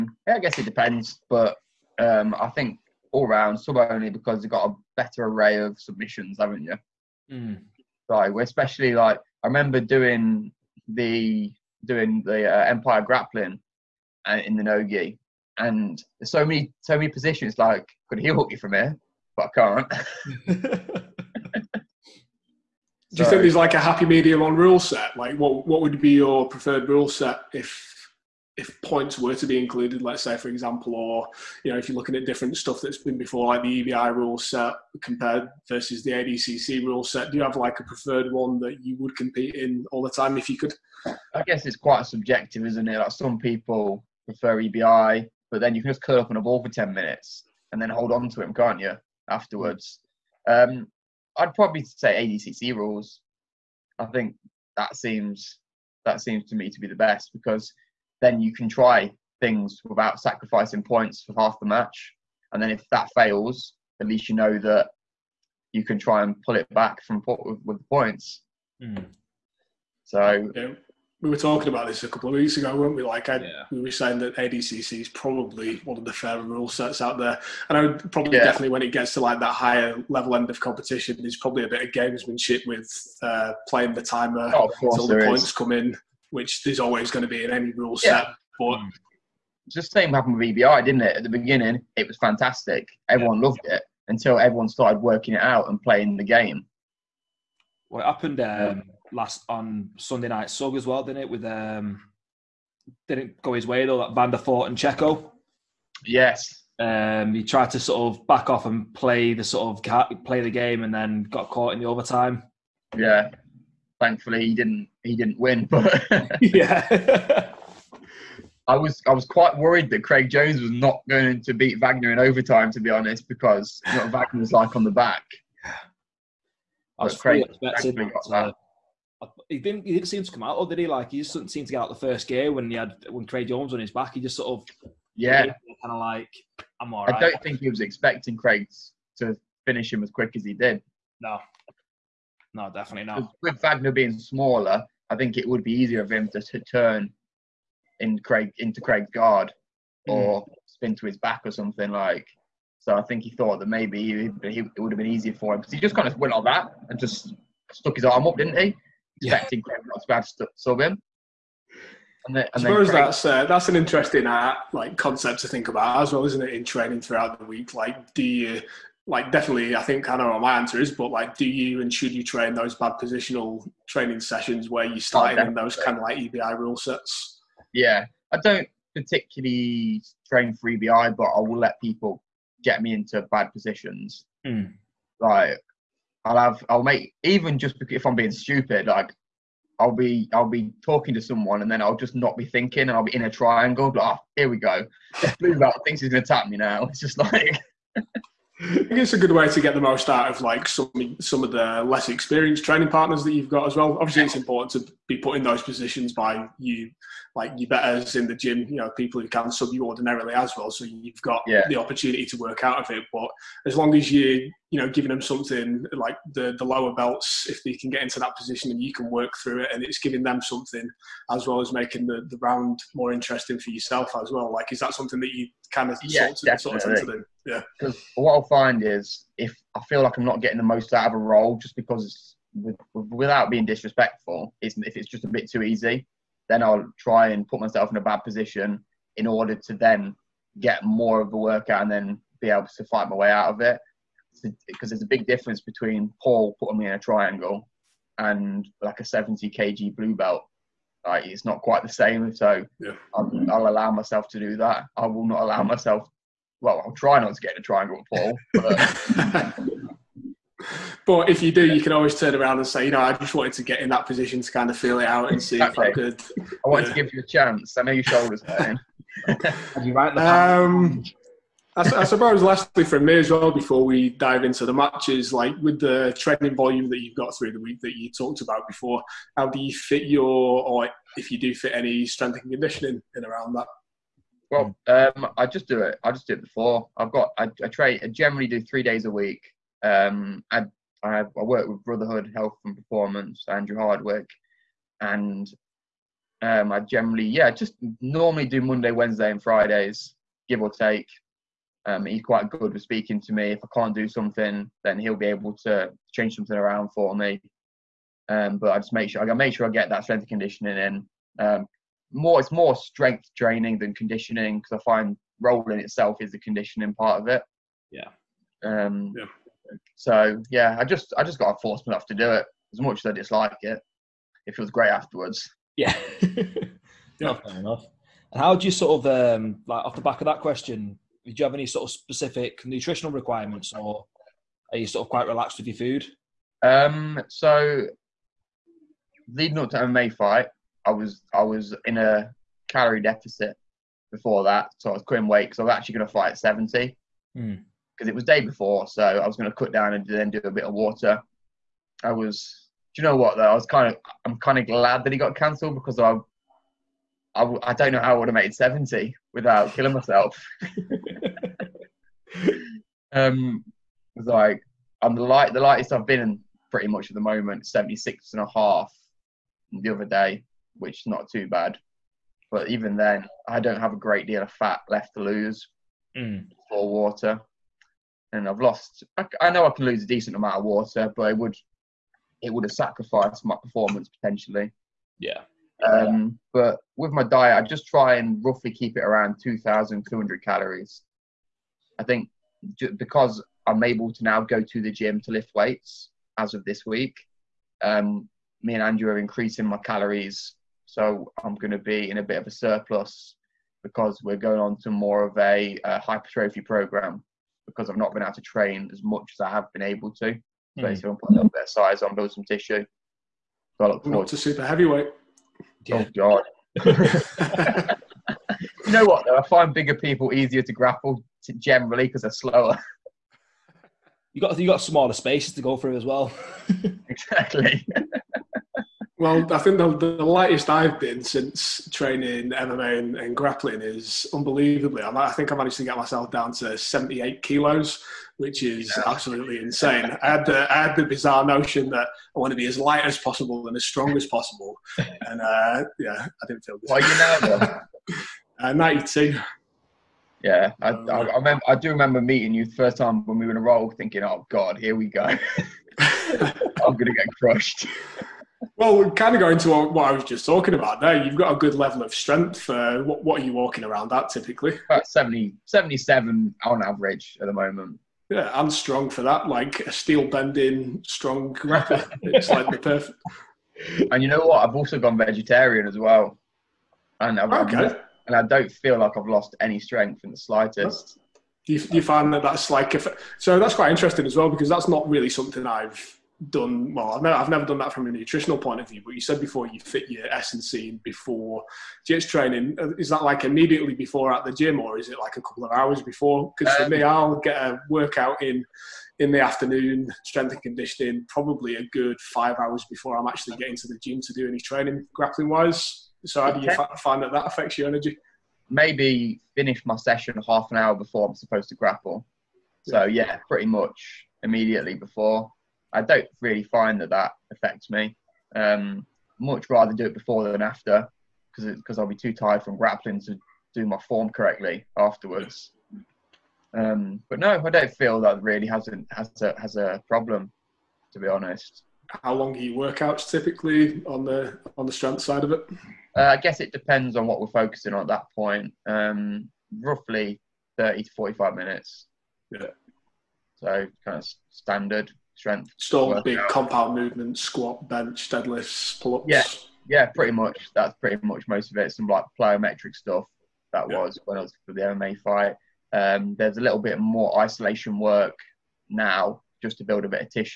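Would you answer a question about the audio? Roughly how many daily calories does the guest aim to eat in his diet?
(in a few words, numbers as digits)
2,200.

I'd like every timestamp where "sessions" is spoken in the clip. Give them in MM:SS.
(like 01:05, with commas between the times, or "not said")
02:54, 08:29.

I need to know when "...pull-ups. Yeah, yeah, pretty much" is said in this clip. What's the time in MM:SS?
09:09.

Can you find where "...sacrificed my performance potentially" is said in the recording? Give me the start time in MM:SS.
06:22.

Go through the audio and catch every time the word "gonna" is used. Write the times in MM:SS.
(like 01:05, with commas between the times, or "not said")
03:16, 07:36.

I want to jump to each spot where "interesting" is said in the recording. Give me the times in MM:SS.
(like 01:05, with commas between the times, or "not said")
02:43, 03:43, 08:03.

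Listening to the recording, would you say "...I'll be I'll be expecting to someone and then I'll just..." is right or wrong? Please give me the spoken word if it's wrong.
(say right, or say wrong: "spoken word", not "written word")
wrong: "talking", not "expecting".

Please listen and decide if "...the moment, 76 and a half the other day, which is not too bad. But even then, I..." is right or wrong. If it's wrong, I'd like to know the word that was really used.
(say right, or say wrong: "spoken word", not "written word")
right.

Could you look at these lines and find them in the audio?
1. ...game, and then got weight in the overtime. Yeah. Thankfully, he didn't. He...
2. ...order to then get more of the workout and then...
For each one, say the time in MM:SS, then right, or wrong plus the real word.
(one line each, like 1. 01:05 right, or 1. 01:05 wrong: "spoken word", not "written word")
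1. 01:50 wrong: "caught", not "weight"
2. 03:59 right.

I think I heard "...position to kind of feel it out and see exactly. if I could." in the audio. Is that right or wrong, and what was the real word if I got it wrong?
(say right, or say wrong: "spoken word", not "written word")
right.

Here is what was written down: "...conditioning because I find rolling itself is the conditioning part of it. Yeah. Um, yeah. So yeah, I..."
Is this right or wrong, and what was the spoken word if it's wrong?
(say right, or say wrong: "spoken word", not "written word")
right.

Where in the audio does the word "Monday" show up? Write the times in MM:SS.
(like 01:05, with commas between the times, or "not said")
04:58.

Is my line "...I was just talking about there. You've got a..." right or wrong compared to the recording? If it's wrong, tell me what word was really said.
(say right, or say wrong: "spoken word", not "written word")
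right.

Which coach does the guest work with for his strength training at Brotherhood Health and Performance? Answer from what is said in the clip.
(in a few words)
Andrew Hardwick.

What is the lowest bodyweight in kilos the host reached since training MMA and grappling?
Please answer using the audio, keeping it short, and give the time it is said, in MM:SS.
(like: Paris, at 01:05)
78 kilos, at 07:16.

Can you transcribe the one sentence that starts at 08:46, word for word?
Um, but no, I don't feel that really hasn't has a has a problem, to be honest.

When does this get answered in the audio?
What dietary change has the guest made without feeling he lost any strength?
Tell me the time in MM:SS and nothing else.
07:55.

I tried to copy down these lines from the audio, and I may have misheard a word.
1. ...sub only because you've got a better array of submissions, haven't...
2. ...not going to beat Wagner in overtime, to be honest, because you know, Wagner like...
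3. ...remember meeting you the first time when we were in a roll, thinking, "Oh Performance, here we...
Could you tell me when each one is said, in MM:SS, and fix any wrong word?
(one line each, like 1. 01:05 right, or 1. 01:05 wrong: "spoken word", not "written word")
1. 00:03 right
2. 02:00 right
3. 07:31 wrong: "God", not "Performance".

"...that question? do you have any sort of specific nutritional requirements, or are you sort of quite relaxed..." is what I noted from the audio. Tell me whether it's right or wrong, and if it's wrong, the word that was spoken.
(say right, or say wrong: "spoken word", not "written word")
right.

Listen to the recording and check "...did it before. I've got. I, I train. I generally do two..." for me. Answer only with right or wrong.
wrong.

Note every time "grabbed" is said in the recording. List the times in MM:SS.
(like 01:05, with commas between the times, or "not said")
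not said.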